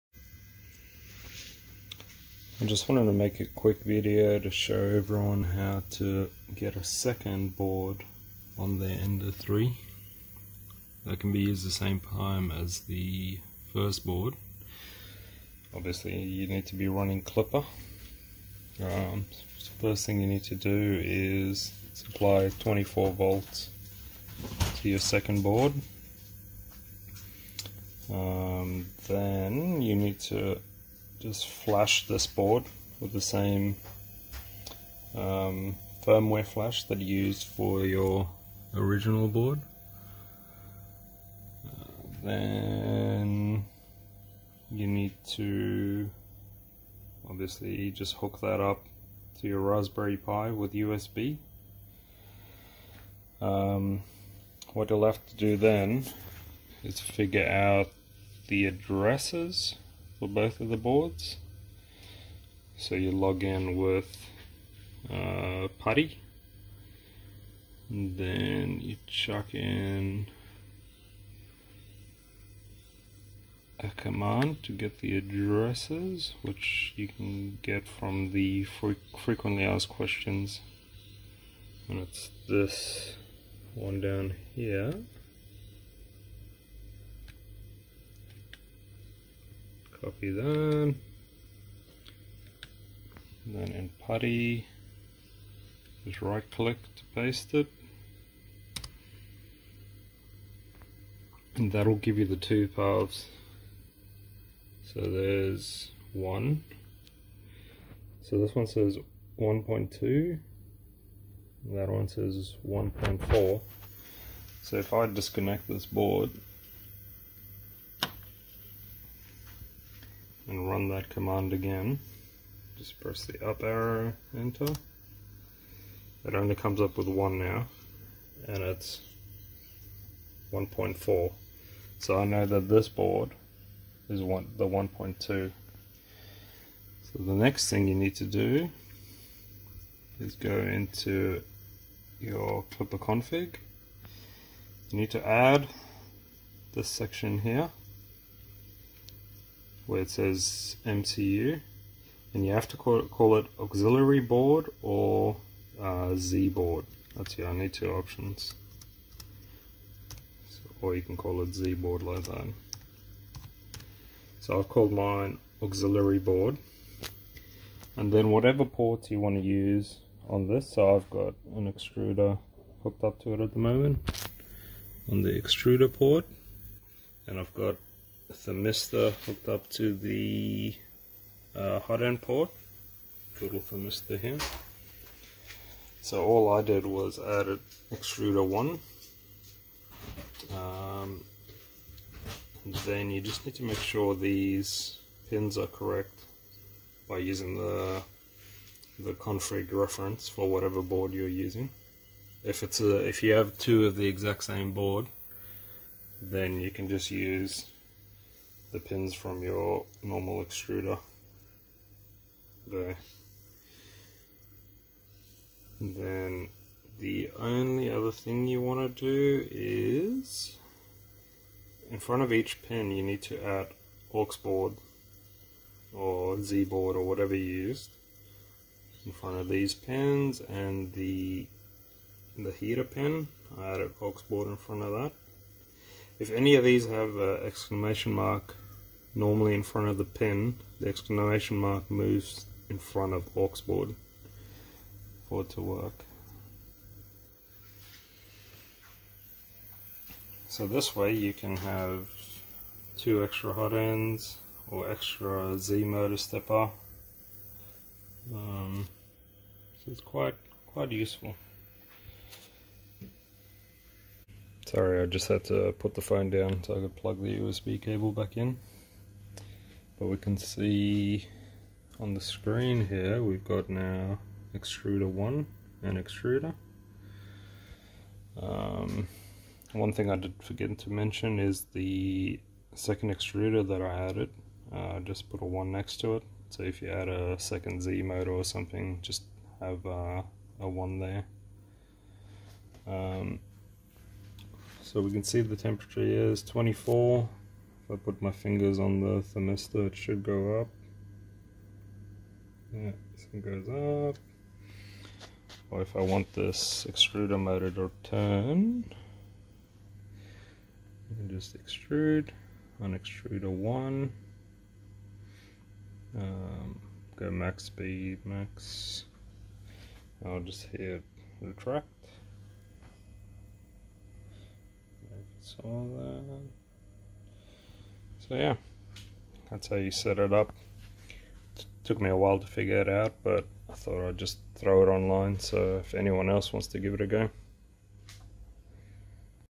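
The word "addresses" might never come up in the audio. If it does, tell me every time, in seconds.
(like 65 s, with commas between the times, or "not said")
58 s, 75 s.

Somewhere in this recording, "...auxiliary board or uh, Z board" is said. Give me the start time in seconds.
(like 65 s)
153 s.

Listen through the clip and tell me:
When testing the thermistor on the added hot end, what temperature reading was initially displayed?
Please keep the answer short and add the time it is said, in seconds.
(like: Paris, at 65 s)
24, at 295 s.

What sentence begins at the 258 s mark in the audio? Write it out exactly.
Um, so it's quite quite useful.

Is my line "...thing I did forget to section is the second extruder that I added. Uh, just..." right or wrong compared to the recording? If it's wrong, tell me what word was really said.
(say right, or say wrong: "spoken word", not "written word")
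wrong: "mention", not "section".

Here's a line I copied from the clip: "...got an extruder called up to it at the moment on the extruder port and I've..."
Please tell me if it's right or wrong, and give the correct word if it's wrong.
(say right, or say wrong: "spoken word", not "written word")
wrong: "hooked", not "called".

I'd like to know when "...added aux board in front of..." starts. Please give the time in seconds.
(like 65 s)
233 s.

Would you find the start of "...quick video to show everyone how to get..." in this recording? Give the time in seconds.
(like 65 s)
3 s.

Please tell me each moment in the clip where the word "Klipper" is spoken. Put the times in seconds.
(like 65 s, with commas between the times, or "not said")
17 s, 142 s.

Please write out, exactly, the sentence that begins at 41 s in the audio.
Uh, then you need to obviously just hook that up to your Raspberry Pi with USB.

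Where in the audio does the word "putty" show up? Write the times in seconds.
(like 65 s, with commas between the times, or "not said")
65 s, 94 s.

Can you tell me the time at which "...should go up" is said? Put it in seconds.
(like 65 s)
299 s.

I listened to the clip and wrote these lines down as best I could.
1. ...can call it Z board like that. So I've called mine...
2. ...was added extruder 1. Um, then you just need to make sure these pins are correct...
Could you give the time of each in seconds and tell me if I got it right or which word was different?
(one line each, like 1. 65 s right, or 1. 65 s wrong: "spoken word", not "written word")
1. 161 s right
2. 186 s right.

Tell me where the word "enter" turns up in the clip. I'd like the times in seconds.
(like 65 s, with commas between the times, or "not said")
124 s.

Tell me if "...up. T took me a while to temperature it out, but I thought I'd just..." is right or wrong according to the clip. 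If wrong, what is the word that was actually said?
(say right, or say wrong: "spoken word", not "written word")
wrong: "figure", not "temperature".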